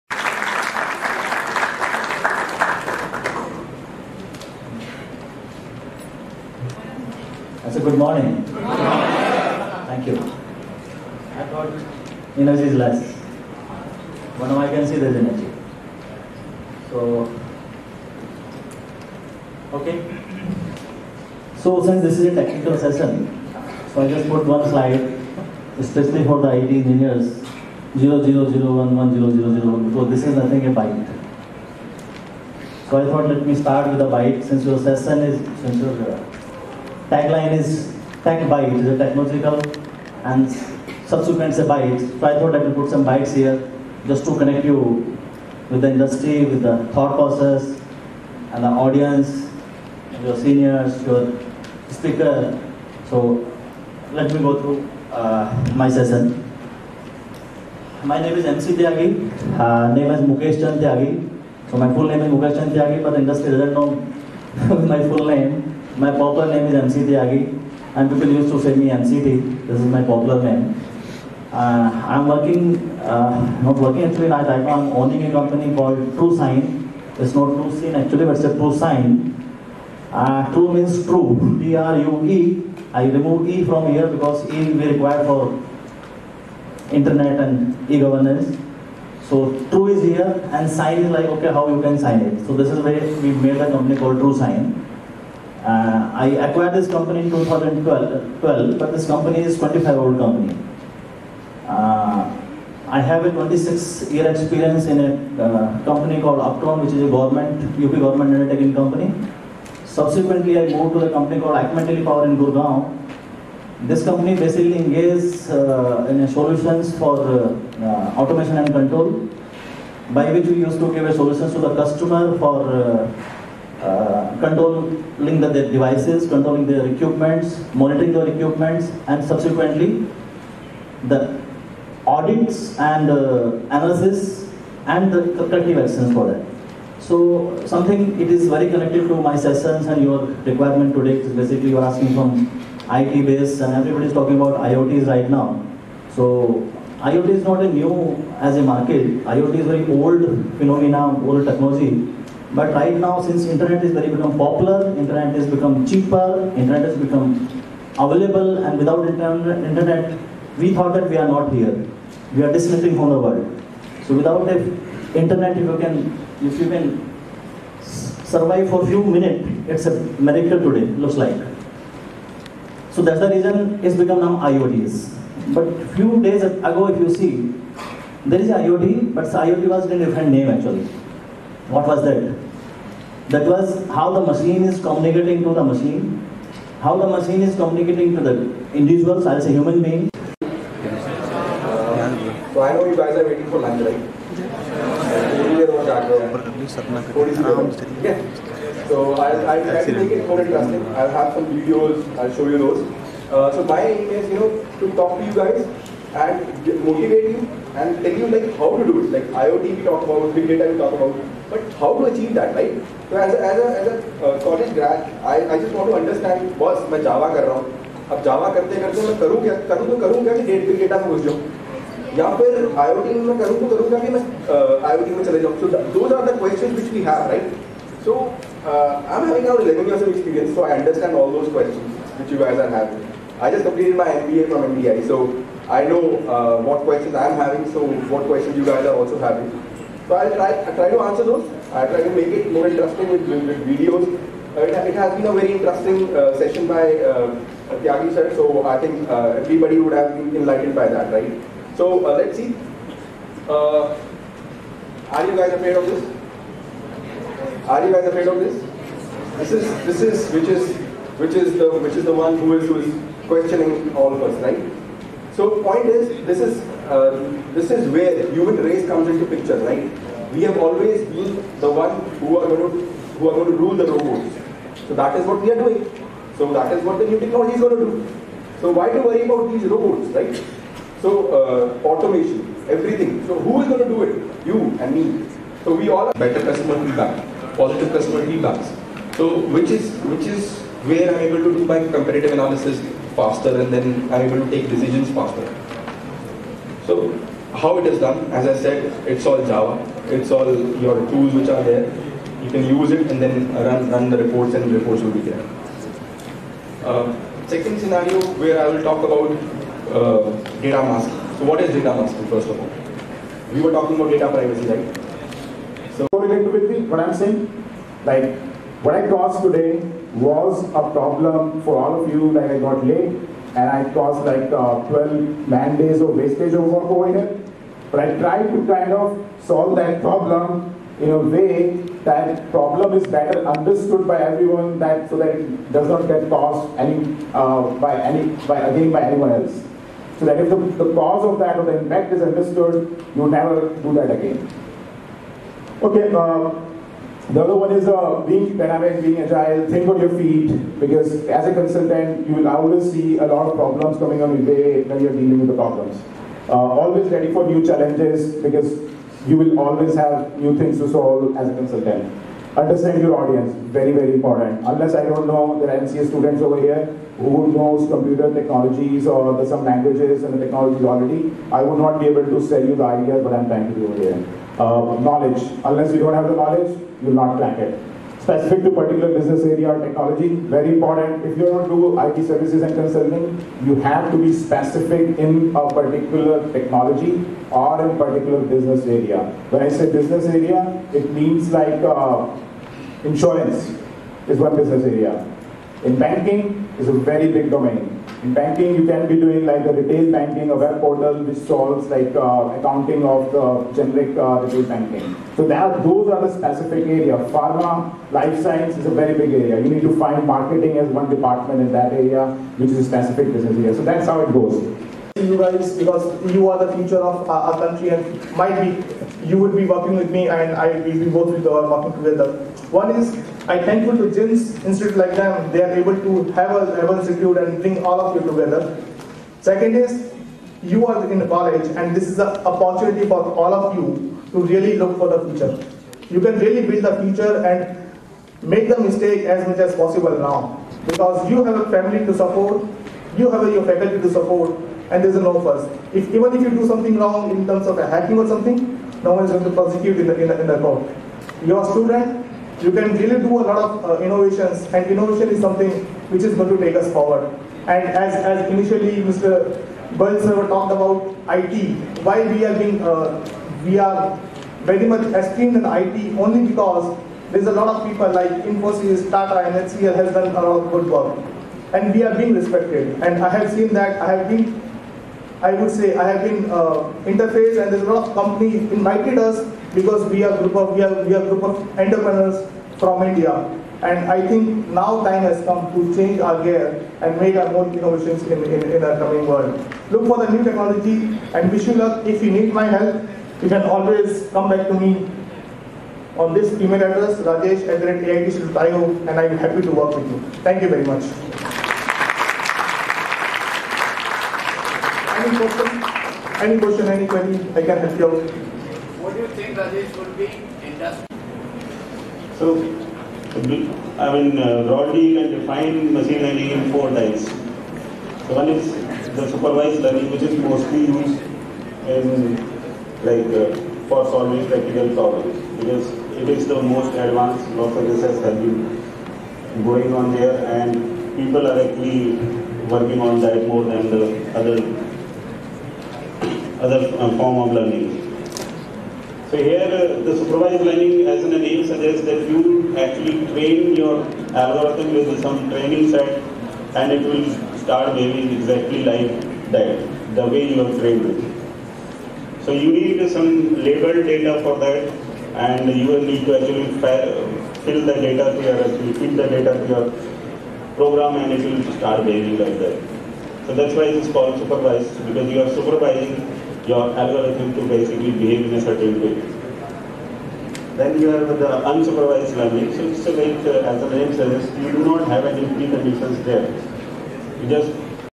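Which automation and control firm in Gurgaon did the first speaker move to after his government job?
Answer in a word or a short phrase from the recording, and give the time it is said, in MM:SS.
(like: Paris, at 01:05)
Acme Power, at 01:51.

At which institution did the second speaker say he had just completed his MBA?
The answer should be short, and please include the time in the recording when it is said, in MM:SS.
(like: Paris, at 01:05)
MDI, at 03:54.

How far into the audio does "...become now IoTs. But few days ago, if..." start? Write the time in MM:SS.
02:53.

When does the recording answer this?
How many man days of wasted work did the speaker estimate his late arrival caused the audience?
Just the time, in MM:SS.
05:24.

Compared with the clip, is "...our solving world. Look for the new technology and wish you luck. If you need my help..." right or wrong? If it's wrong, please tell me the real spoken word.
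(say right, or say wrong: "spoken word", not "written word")
wrong: "coming", not "solving".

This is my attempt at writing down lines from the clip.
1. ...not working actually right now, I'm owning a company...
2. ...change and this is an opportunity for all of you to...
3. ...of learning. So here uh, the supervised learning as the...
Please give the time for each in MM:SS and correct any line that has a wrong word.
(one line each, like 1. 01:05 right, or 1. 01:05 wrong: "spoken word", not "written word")
1. 01:13 right
2. 07:11 wrong: "college", not "change"
3. 08:57 right.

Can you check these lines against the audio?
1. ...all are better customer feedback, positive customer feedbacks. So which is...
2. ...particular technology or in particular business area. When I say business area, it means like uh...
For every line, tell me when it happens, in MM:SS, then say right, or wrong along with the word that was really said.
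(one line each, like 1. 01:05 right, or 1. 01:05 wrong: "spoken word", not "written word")
1. 04:45 right
2. 06:25 right.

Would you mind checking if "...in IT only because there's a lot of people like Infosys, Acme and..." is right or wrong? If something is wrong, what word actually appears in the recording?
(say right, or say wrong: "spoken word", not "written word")
wrong: "Tata", not "Acme".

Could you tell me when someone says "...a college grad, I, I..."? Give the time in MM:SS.
03:34.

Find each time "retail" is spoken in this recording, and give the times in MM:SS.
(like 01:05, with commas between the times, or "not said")
06:39, 06:44.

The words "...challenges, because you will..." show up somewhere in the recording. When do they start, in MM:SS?
05:57.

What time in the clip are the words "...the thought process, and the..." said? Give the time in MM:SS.
00:46.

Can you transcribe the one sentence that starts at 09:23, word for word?
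So that's why it is called supervised because you are supervising your algorithm to basically behave in a certain way.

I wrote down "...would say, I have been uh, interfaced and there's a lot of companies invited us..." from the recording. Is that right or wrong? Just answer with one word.
right.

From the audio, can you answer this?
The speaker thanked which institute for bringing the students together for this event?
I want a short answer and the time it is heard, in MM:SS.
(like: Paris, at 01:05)
JIMS Institute, at 07:04.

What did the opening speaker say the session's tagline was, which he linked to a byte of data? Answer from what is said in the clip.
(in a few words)
Techbyte.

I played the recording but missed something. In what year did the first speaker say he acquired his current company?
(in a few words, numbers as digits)
2012.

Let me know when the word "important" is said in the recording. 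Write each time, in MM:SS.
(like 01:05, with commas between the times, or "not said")
06:04, 06:20.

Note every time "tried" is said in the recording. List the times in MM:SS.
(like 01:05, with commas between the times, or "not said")
05:28.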